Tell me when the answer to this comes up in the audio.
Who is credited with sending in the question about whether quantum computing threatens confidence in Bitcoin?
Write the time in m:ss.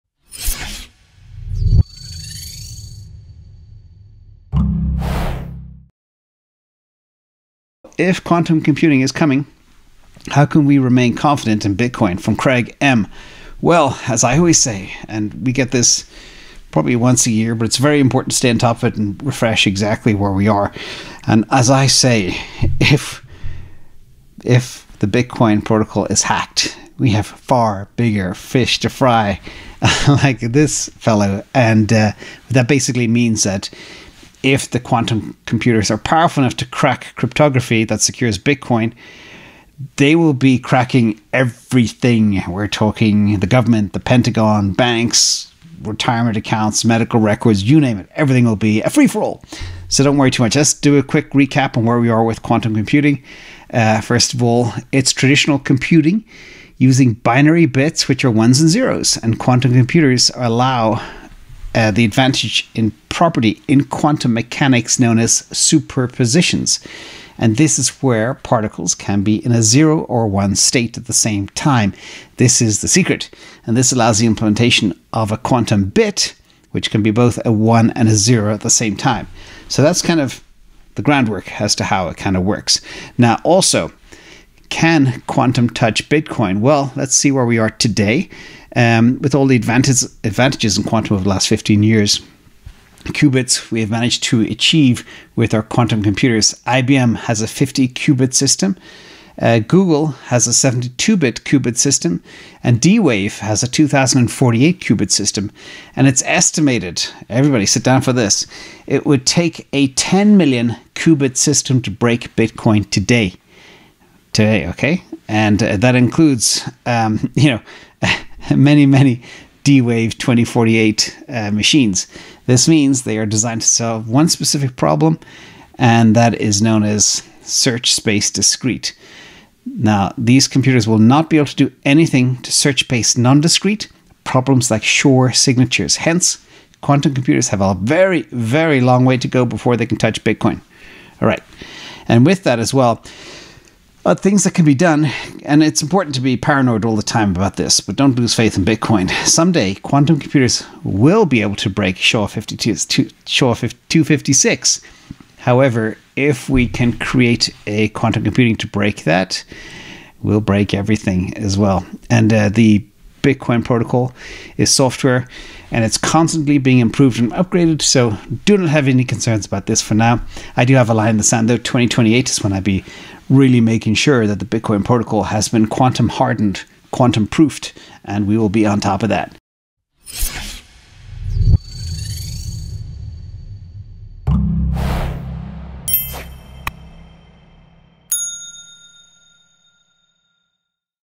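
0:12.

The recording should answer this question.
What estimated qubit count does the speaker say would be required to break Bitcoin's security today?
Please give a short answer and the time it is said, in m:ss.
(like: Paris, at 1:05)
10 million, at 1:49.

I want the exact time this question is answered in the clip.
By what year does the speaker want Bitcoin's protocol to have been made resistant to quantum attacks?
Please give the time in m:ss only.
2:51.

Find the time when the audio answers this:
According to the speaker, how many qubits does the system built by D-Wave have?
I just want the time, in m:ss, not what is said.
1:43.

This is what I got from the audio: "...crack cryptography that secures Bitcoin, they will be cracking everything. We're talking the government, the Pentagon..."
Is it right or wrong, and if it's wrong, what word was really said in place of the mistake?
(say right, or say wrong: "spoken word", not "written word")
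right.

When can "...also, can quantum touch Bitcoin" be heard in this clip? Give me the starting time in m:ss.
1:23.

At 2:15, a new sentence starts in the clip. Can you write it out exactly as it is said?
Hence, quantum computers have a very, very long way to go before they can touch Bitcoin.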